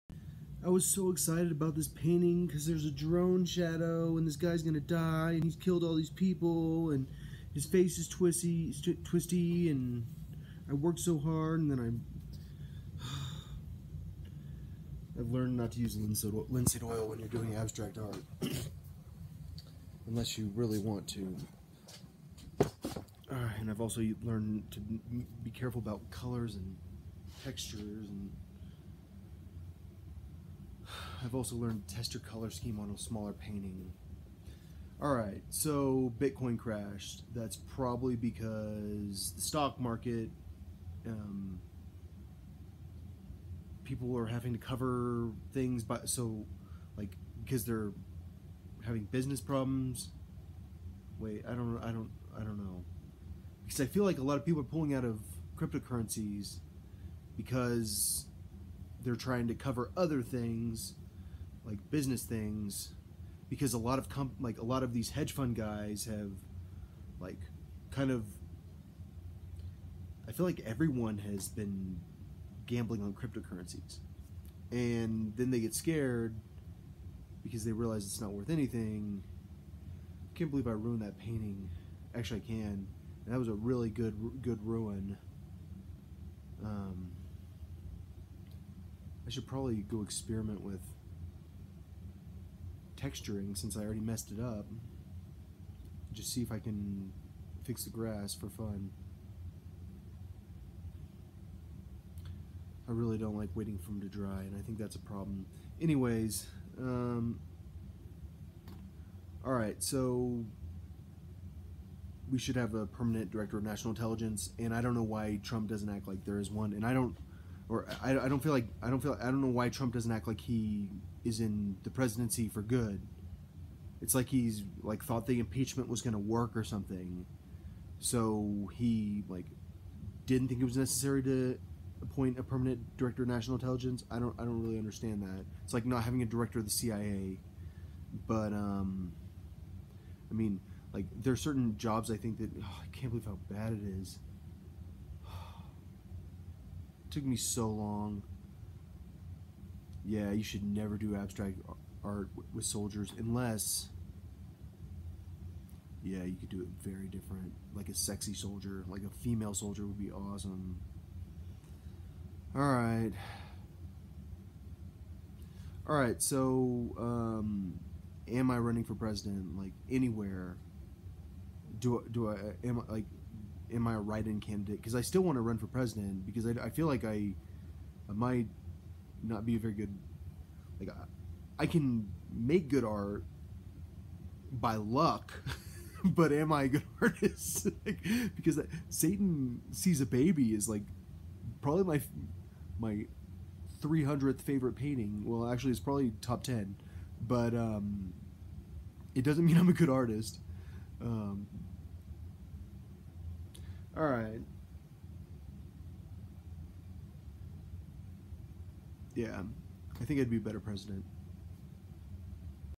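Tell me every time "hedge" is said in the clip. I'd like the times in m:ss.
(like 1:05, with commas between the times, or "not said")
1:05.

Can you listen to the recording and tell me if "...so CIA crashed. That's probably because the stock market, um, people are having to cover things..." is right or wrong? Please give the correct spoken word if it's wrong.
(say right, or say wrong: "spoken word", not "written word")
wrong: "Bitcoin", not "CIA".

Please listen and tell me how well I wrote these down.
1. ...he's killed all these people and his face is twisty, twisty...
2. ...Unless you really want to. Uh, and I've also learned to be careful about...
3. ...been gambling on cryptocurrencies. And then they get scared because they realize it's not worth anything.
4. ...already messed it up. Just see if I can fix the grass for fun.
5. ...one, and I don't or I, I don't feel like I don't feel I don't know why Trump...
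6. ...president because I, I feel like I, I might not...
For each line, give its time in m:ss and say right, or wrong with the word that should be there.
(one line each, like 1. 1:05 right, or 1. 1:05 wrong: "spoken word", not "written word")
1. 0:05 right
2. 0:20 right
3. 1:11 right
4. 1:33 right
5. 1:56 right
6. 2:55 right.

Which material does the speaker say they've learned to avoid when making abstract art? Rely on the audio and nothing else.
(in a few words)
Linseed oil.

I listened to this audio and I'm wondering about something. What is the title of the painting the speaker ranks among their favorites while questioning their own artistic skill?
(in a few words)
Satan Sees a Baby.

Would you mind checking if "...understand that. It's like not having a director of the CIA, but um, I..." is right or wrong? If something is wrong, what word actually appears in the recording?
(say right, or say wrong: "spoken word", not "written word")
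right.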